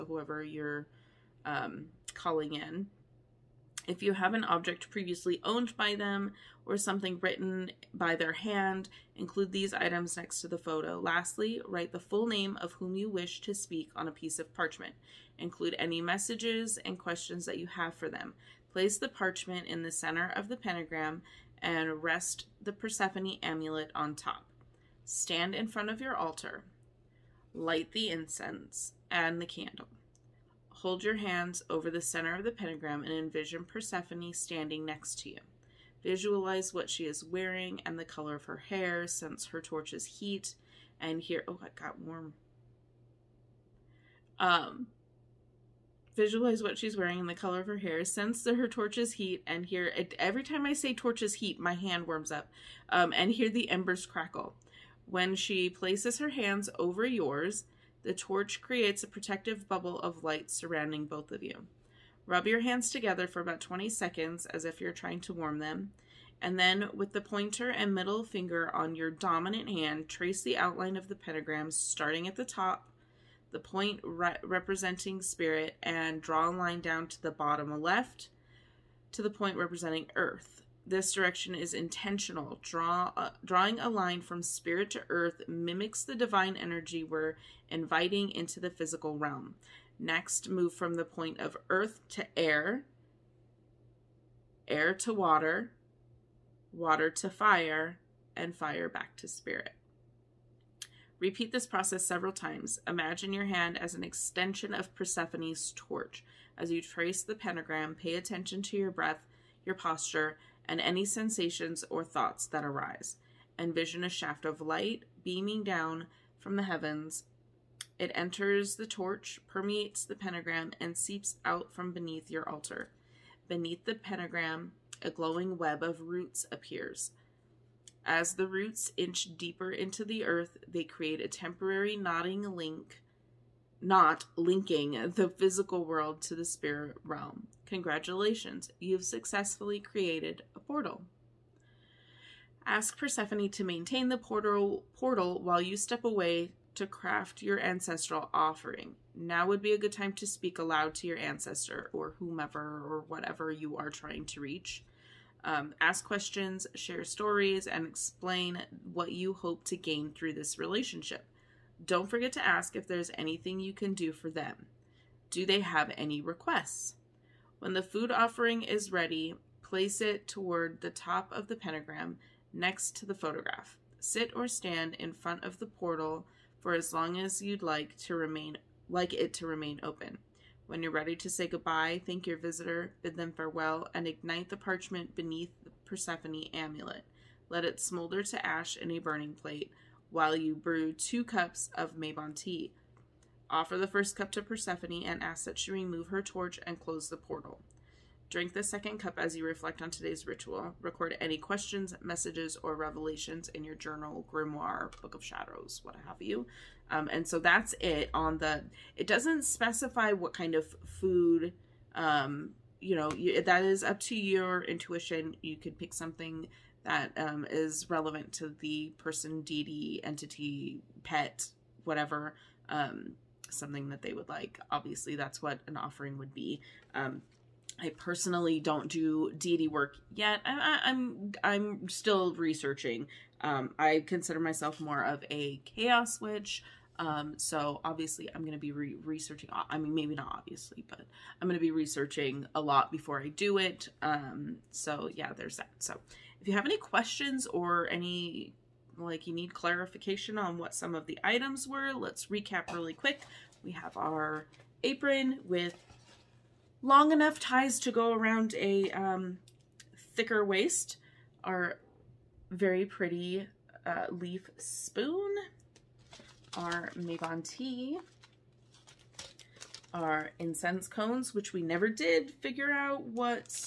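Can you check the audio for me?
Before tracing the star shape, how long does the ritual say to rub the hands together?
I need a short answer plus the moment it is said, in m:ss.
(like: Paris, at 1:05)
20 seconds, at 1:03.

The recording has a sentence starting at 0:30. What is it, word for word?
Hold your hands over the center of the pentagram and envision Persephone standing next to you.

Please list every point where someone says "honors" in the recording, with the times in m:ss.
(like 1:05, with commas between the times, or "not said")
not said.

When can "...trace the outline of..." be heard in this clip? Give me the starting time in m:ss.
1:10.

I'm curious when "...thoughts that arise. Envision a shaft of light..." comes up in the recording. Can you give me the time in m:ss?
1:52.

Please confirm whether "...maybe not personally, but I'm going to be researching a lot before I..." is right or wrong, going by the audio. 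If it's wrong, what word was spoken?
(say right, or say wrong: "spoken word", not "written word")
wrong: "obviously", not "personally".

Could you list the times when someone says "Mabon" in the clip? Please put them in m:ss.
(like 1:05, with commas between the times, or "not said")
3:11, 4:26.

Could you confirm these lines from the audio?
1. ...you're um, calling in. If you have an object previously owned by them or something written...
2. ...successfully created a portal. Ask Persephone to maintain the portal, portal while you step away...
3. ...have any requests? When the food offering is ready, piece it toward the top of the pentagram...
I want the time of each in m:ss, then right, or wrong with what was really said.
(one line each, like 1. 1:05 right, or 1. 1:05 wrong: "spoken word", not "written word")
1. 0:00 right
2. 2:19 right
3. 2:45 wrong: "place", not "piece".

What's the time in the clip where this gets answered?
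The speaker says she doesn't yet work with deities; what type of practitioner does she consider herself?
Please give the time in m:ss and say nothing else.
3:55.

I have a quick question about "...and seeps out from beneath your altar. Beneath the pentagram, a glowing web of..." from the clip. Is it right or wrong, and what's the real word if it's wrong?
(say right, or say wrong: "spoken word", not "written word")
right.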